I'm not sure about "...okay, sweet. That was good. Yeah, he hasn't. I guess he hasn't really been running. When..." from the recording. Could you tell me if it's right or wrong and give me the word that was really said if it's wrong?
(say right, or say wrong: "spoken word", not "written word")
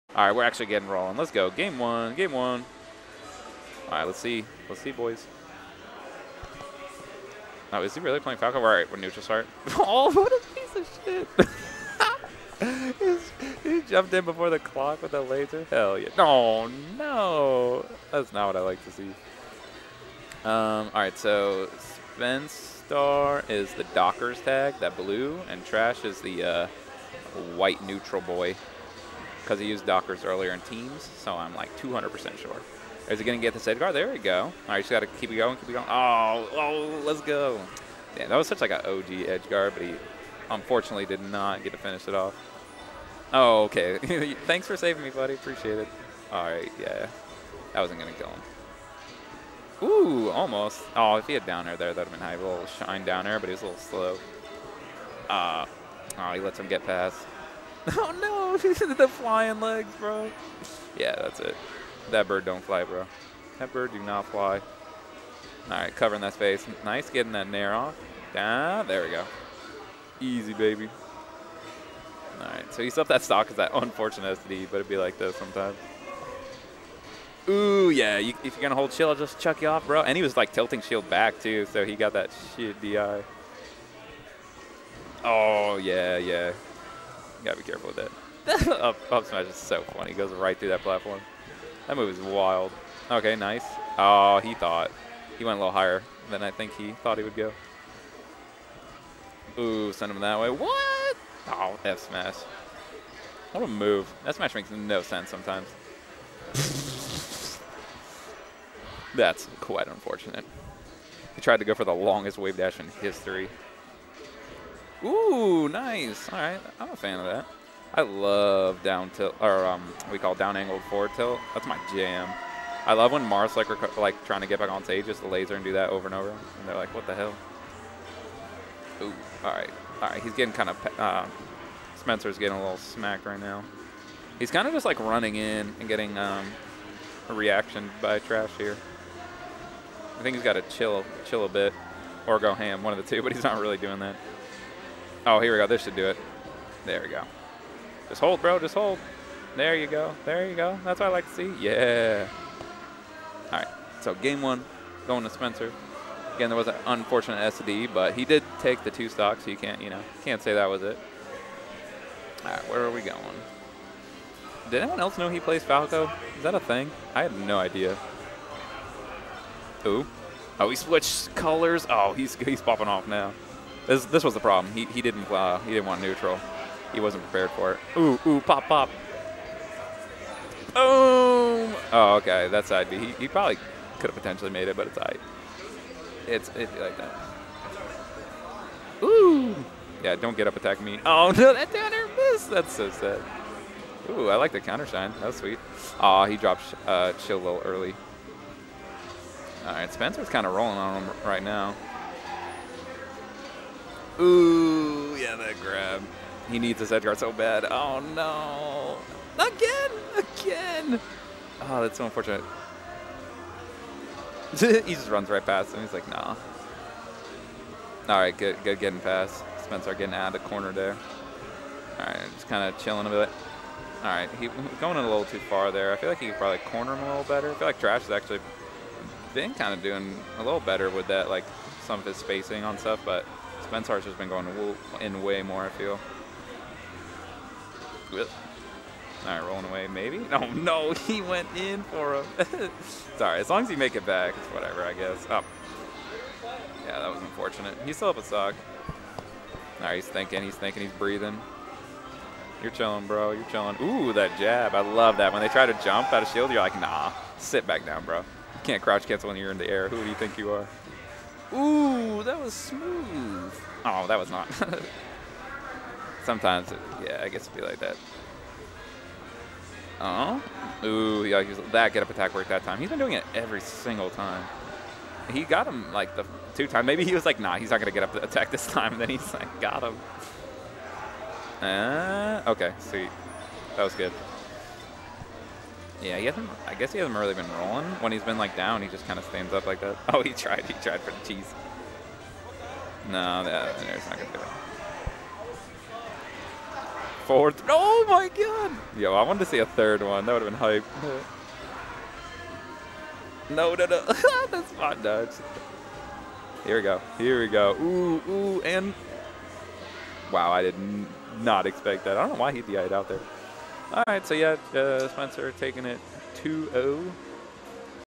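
wrong: "rolling", not "running".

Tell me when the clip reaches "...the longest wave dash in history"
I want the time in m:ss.
1:51.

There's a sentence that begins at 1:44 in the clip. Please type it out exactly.
That smash makes no sense sometimes.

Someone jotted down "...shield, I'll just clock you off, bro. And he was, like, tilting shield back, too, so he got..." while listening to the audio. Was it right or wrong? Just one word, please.
wrong.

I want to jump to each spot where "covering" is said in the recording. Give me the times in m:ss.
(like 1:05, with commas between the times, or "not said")
1:05.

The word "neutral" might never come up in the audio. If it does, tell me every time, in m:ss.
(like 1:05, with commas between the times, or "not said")
0:08, 0:27, 2:56.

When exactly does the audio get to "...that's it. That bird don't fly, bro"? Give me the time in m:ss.
1:01.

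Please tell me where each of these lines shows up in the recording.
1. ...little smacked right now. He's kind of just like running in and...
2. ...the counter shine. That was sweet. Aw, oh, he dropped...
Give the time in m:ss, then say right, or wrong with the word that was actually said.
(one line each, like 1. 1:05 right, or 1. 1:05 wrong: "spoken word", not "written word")
1. 2:12 right
2. 3:14 right.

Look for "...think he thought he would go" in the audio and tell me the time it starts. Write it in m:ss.
1:36.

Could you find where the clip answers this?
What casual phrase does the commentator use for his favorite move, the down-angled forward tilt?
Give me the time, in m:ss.
2:01.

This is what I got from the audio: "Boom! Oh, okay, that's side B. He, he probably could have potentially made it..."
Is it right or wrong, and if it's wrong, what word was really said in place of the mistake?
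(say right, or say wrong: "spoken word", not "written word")
right.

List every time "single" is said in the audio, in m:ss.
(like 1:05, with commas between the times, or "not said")
4:33.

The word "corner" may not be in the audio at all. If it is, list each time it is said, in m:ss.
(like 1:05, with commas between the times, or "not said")
3:40, 3:46.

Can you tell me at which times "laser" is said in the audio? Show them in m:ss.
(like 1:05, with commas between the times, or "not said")
0:15, 2:05.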